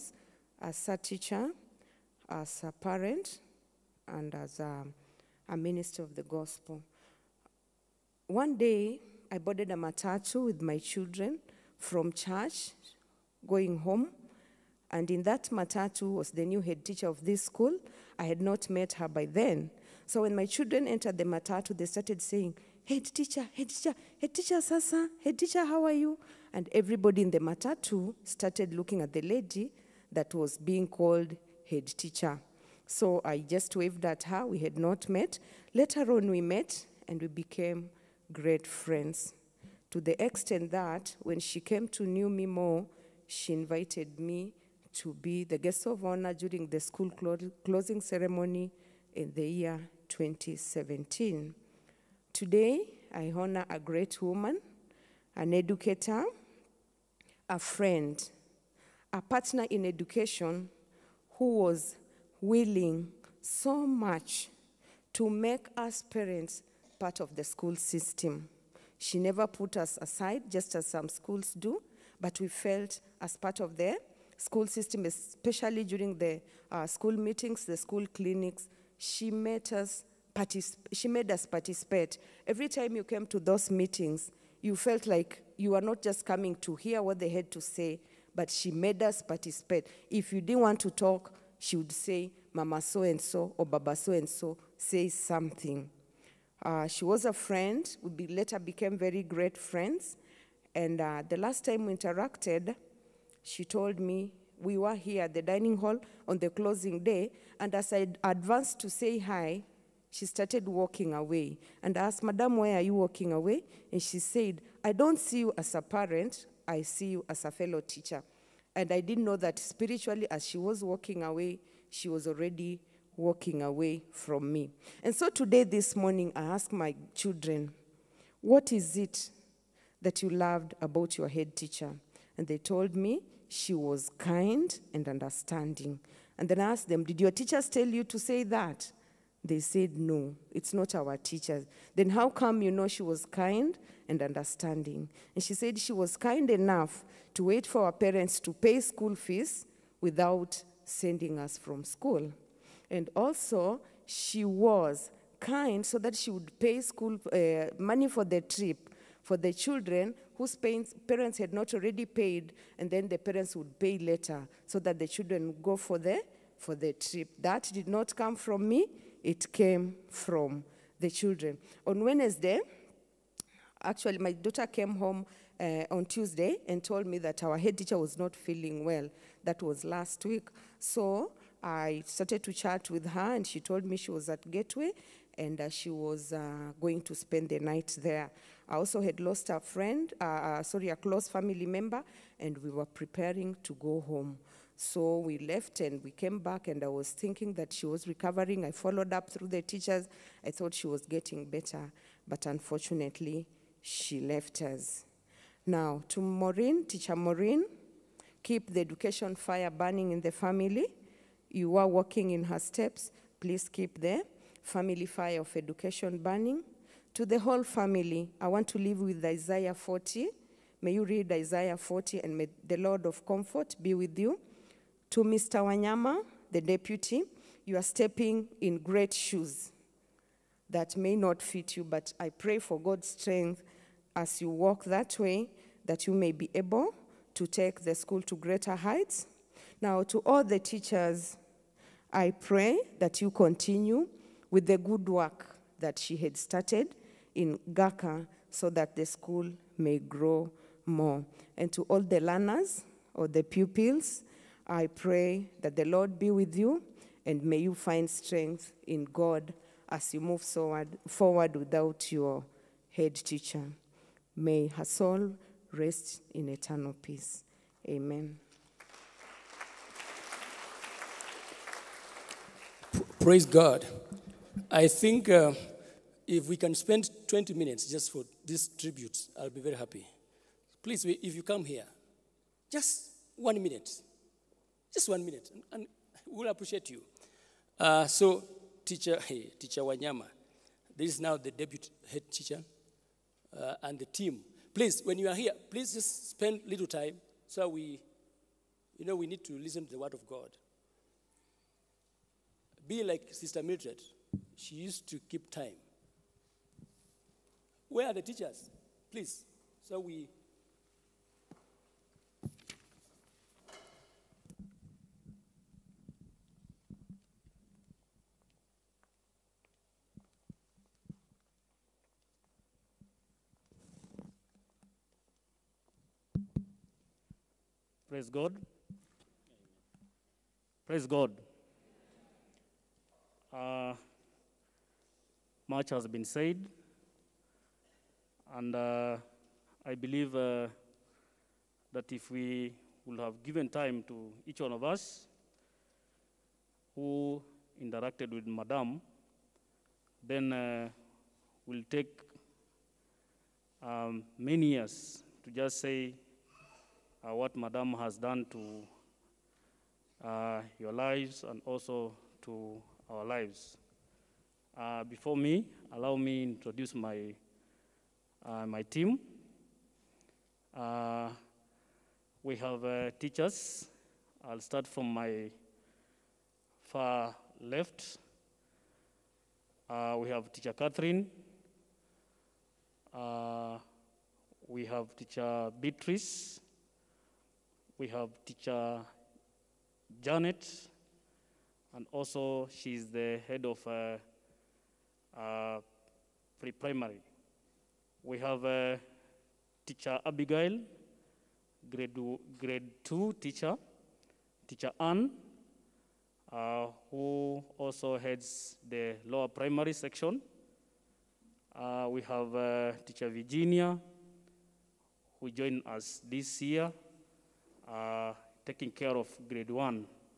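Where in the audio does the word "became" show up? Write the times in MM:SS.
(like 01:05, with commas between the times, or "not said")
00:37, 01:38.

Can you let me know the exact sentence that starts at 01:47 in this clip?
And as I advanced to say hi, she started walking away.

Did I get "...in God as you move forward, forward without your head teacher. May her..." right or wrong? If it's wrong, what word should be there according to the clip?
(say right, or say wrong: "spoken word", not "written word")
right.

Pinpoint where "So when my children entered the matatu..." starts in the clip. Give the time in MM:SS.
00:20.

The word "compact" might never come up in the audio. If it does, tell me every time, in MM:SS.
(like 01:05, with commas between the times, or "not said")
not said.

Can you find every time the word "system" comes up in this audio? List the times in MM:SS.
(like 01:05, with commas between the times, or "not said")
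01:07, 01:14.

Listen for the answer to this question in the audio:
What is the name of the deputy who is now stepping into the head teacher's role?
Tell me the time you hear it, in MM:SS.
03:45.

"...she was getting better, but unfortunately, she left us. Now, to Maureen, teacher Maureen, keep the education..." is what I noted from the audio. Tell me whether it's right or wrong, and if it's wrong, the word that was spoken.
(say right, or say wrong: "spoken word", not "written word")
right.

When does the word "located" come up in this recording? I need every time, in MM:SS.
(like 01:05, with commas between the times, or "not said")
not said.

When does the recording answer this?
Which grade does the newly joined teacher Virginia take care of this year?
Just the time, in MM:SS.
06:59.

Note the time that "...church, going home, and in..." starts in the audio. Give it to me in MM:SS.
00:12.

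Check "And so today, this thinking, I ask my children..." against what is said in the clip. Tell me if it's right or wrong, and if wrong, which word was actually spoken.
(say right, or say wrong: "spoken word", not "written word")
wrong: "morning", not "thinking".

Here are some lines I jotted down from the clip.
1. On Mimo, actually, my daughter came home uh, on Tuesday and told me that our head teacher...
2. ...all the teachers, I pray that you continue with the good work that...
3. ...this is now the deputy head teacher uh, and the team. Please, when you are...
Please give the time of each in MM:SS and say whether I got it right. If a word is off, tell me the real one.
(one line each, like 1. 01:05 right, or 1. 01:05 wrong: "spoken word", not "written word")
1. 02:51 wrong: "Wednesday", not "Mimo"
2. 04:00 right
3. 04:50 right.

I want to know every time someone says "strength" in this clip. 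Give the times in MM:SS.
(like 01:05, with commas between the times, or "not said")
03:53, 04:18.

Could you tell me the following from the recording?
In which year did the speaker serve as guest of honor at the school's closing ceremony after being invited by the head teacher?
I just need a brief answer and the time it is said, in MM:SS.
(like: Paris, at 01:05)
2017, at 00:50.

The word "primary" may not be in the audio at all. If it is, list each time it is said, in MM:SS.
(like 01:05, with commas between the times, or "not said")
06:36, 06:49.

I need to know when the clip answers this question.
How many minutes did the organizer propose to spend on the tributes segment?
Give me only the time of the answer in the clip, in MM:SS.
04:37.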